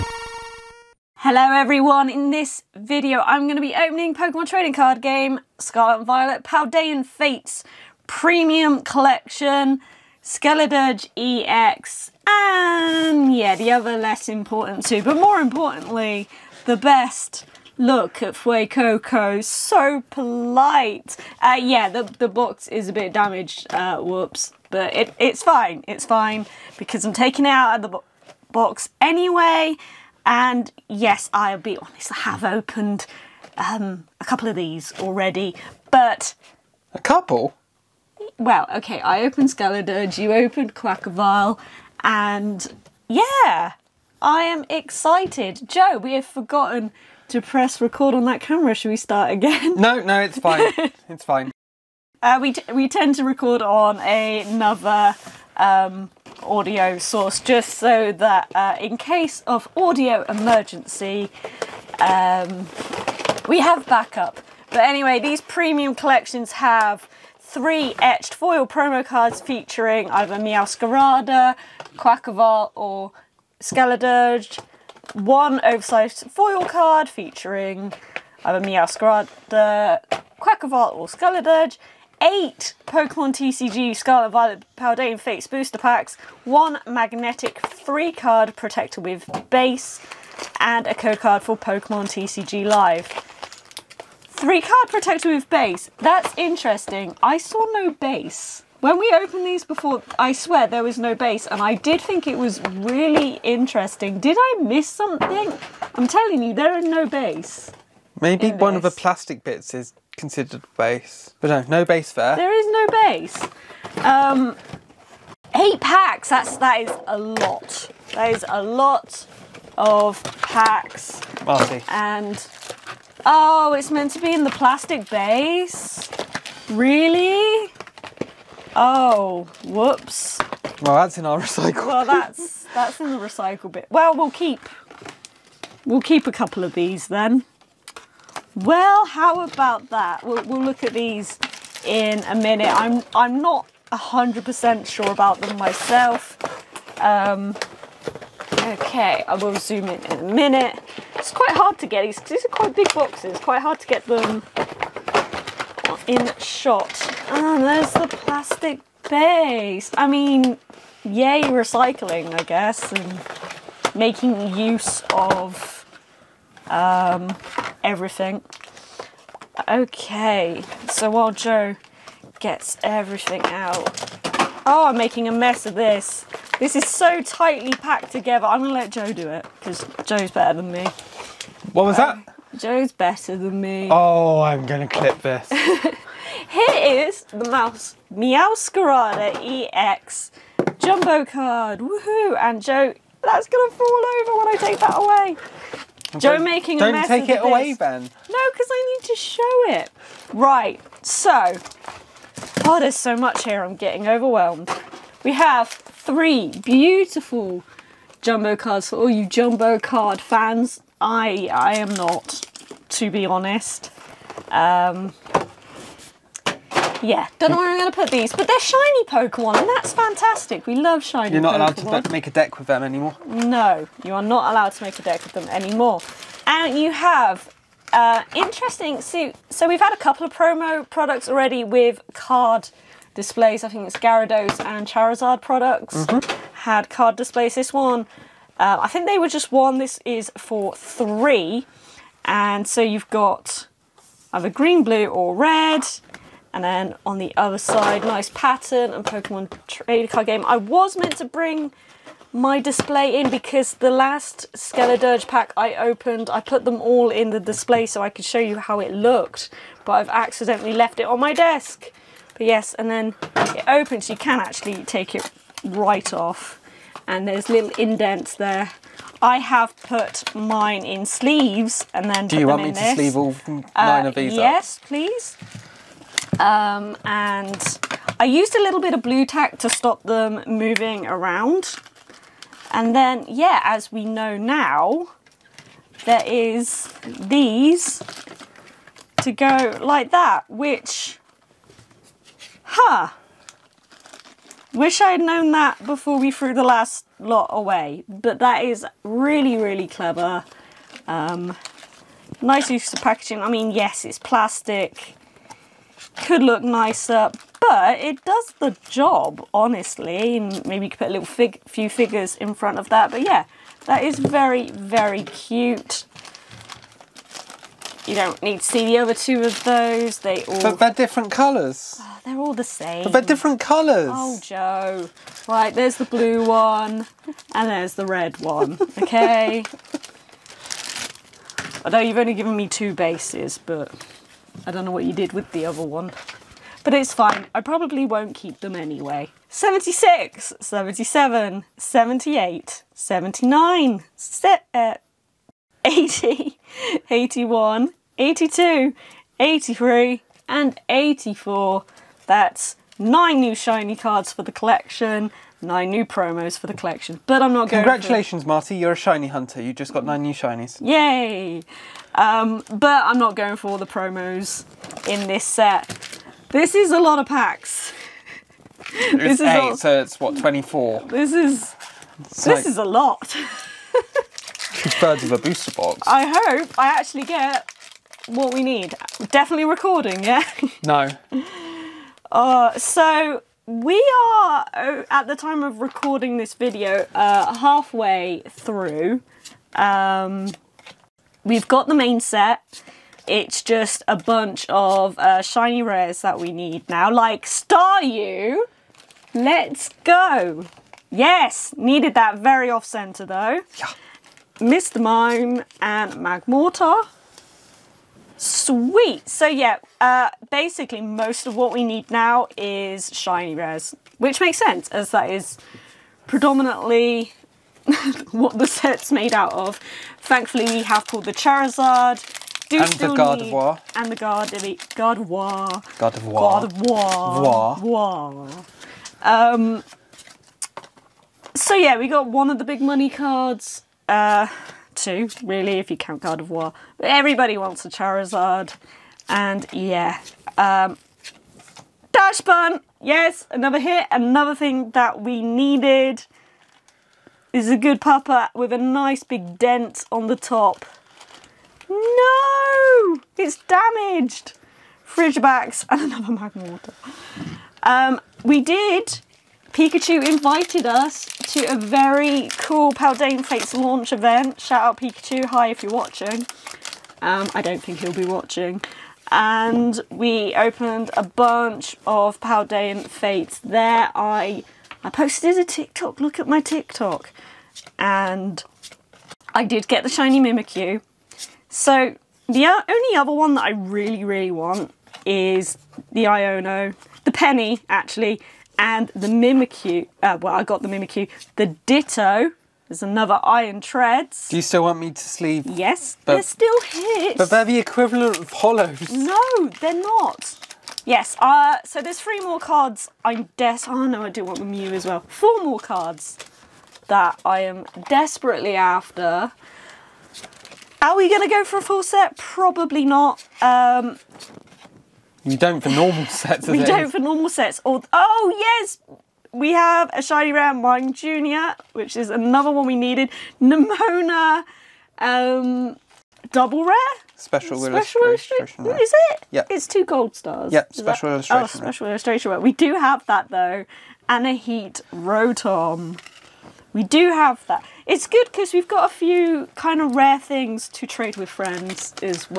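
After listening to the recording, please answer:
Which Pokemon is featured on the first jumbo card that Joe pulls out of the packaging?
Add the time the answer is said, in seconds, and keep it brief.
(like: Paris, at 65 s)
Meowscarada EX, at 188 s.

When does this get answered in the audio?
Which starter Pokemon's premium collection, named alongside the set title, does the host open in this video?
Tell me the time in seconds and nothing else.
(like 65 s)
10 s.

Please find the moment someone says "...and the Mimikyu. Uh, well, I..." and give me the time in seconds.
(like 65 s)
488 s.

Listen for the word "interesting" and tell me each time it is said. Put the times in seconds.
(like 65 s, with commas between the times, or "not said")
96 s, 103 s, 228 s.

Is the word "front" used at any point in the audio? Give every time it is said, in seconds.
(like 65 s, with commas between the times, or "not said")
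312 s.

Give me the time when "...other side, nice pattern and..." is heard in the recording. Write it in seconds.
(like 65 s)
247 s.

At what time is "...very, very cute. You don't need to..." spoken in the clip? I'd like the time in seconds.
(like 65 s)
314 s.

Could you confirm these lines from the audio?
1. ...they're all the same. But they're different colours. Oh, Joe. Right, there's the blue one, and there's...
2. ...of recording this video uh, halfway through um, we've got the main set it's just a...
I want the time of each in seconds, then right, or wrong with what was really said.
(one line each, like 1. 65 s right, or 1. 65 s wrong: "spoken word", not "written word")
1. 322 s right
2. 385 s right.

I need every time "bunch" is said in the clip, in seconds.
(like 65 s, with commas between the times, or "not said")
394 s, 471 s.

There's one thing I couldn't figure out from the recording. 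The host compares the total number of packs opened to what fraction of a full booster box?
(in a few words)
Two thirds.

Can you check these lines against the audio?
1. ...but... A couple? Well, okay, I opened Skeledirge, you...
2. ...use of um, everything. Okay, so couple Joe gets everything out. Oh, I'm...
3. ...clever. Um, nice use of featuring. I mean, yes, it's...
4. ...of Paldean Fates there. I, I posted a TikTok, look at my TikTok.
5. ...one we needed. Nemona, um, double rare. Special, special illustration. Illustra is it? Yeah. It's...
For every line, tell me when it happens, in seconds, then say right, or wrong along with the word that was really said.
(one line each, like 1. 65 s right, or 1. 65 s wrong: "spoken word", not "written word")
1. 35 s right
2. 164 s wrong: "while", not "couple"
3. 299 s wrong: "packaging", not "featuring"
4. 472 s right
5. 522 s right.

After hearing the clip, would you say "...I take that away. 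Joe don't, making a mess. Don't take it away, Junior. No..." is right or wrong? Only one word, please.
wrong.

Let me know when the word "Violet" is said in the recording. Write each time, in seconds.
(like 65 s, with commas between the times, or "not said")
6 s, 84 s.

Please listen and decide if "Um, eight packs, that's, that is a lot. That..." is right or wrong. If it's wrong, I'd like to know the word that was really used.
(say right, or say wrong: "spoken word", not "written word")
right.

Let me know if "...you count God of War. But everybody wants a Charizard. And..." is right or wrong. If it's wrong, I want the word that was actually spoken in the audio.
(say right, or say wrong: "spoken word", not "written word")
right.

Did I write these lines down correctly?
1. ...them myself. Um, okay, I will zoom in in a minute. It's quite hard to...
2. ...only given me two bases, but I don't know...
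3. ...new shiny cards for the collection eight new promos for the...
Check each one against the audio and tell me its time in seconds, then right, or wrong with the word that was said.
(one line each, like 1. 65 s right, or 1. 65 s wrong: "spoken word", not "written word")
1. 145 s right
2. 332 s right
3. 353 s wrong: "nine", not "eight".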